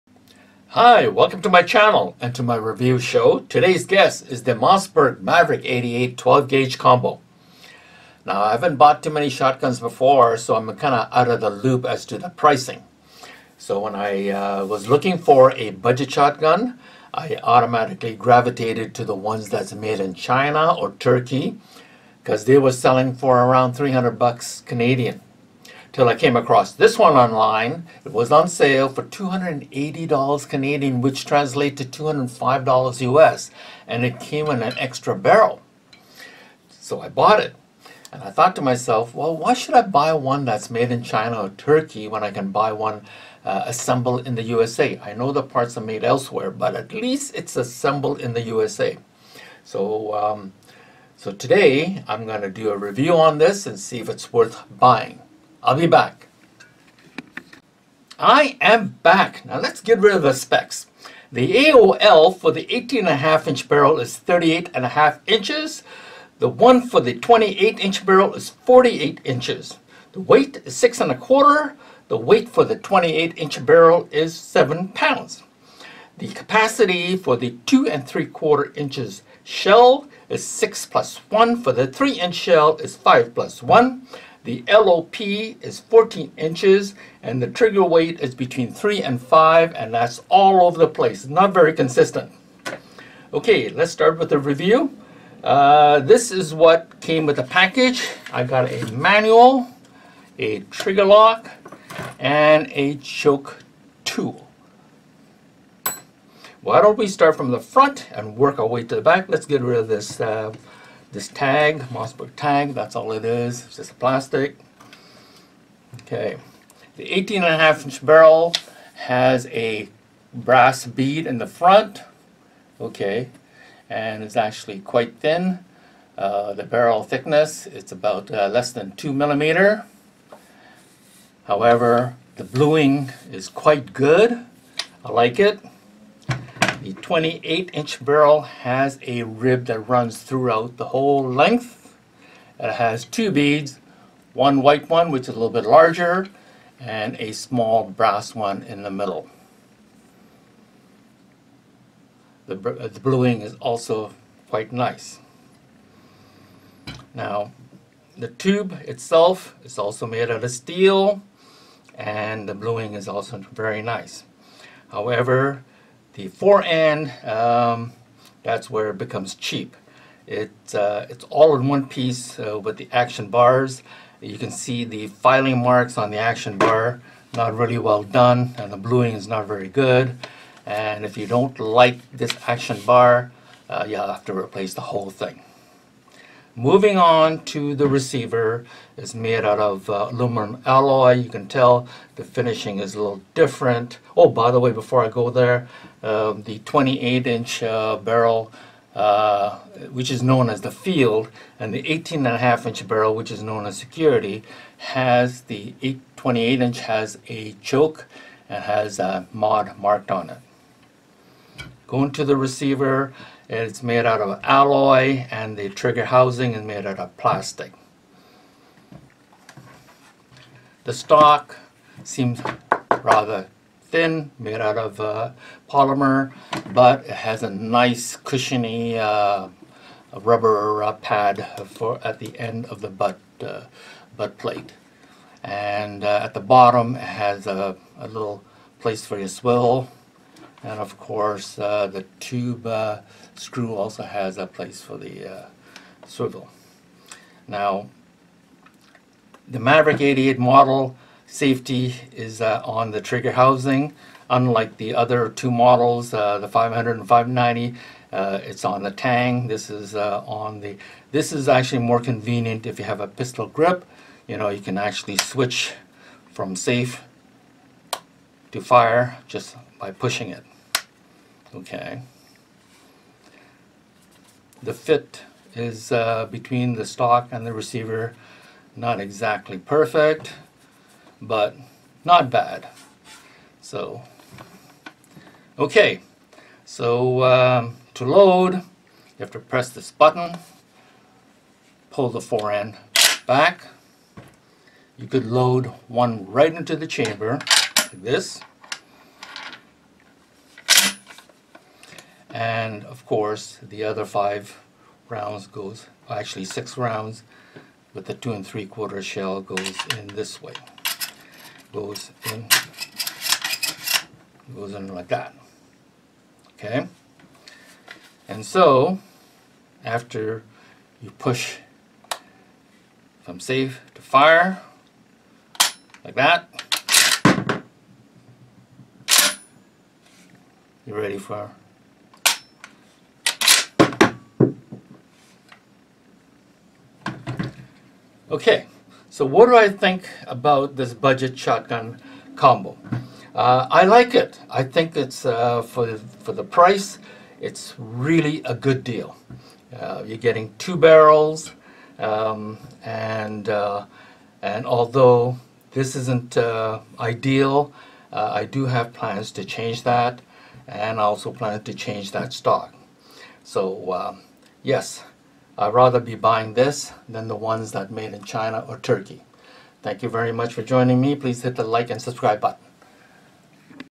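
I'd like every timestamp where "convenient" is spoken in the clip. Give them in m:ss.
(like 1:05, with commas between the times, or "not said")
4:21.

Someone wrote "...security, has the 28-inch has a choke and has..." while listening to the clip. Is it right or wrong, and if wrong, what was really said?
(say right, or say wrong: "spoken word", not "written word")
right.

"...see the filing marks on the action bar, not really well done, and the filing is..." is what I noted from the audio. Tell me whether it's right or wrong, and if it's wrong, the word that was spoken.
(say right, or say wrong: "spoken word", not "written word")
wrong: "bluing", not "filing".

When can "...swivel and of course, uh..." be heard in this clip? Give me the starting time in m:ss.
3:59.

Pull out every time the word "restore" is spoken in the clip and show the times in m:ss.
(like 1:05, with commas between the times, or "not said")
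not said.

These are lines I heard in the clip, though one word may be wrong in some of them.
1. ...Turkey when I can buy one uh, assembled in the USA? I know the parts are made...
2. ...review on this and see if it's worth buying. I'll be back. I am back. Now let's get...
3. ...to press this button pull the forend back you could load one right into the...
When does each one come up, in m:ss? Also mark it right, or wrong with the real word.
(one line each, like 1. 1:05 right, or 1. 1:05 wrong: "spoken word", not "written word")
1. 0:41 right
2. 0:52 right
3. 4:49 right.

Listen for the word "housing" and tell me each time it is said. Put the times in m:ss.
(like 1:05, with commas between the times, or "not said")
3:36, 4:13.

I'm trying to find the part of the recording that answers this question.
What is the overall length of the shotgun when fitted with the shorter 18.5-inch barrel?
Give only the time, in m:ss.
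1:04.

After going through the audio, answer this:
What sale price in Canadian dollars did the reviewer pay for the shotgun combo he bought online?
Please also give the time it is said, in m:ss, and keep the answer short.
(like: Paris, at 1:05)
$280, at 0:29.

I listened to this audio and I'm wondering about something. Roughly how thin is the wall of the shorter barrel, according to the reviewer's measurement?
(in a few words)
less than 2 millimeters.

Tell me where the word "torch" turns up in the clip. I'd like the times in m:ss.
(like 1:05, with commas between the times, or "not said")
not said.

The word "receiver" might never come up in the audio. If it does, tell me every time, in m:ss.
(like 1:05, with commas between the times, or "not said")
3:07, 3:32, 4:37.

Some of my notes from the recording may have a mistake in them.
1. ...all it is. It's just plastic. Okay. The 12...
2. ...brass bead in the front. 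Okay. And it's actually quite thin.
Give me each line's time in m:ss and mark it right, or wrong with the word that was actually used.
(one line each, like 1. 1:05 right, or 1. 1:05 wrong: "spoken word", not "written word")
1. 1:52 wrong: "18", not "12"
2. 2:00 right.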